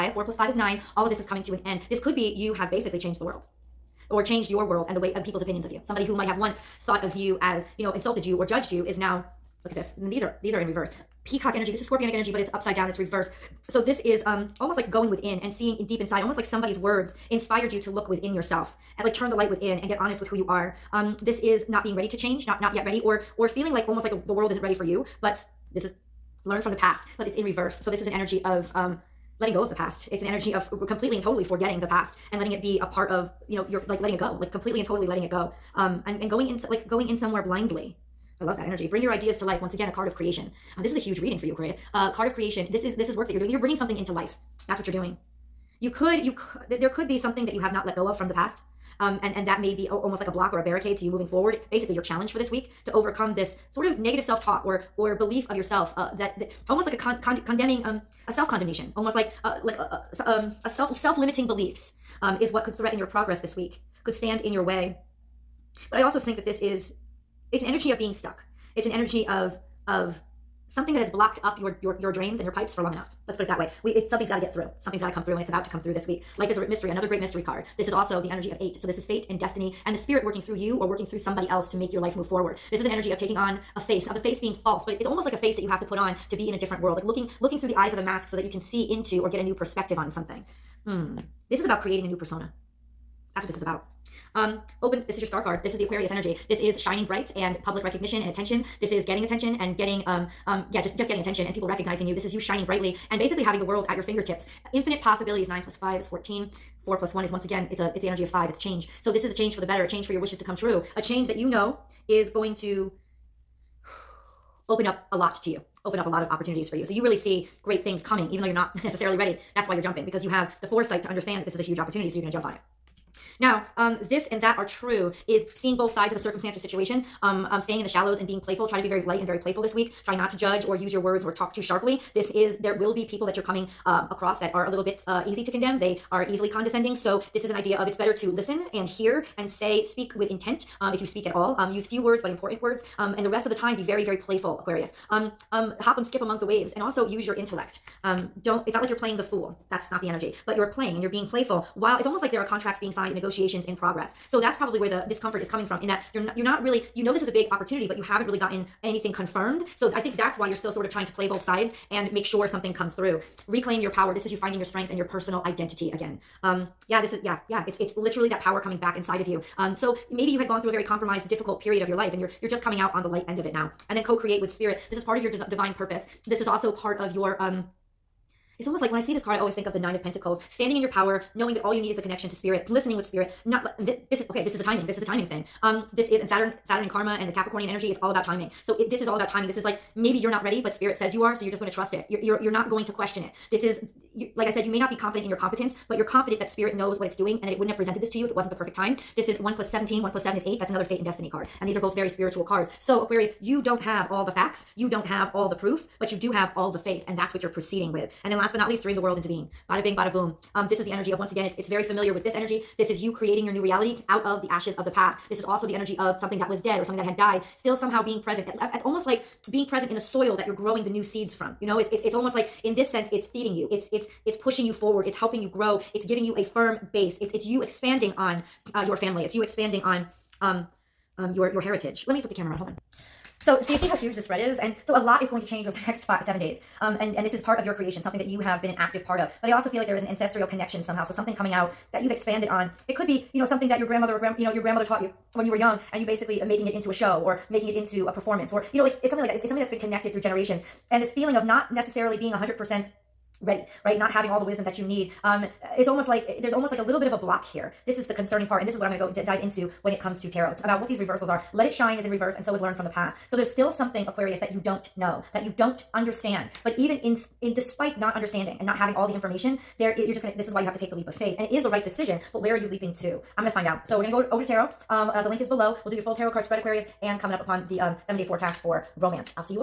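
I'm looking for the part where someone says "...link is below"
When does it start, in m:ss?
4:35.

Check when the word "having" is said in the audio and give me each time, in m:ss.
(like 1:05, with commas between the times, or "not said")
1:43, 4:14, 4:28.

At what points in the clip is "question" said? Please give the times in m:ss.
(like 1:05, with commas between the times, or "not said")
3:12.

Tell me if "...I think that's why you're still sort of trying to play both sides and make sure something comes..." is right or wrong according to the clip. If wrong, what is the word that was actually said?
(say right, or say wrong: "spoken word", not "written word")
right.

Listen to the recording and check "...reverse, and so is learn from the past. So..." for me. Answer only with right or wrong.
right.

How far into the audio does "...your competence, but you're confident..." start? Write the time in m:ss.
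3:15.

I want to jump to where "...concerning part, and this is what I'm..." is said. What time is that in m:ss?
4:18.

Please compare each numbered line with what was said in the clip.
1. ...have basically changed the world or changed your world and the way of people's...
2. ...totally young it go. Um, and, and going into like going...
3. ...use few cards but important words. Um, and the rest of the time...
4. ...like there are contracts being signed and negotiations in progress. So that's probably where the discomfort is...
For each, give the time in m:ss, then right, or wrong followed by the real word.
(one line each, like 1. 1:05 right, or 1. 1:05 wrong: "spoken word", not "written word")
1. 0:02 right
2. 0:34 wrong: "letting", not "young"
3. 2:21 wrong: "words", not "cards"
4. 2:32 right.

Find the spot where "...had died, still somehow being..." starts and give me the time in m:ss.
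3:37.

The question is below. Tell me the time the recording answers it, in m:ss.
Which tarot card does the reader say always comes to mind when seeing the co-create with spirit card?
2:59.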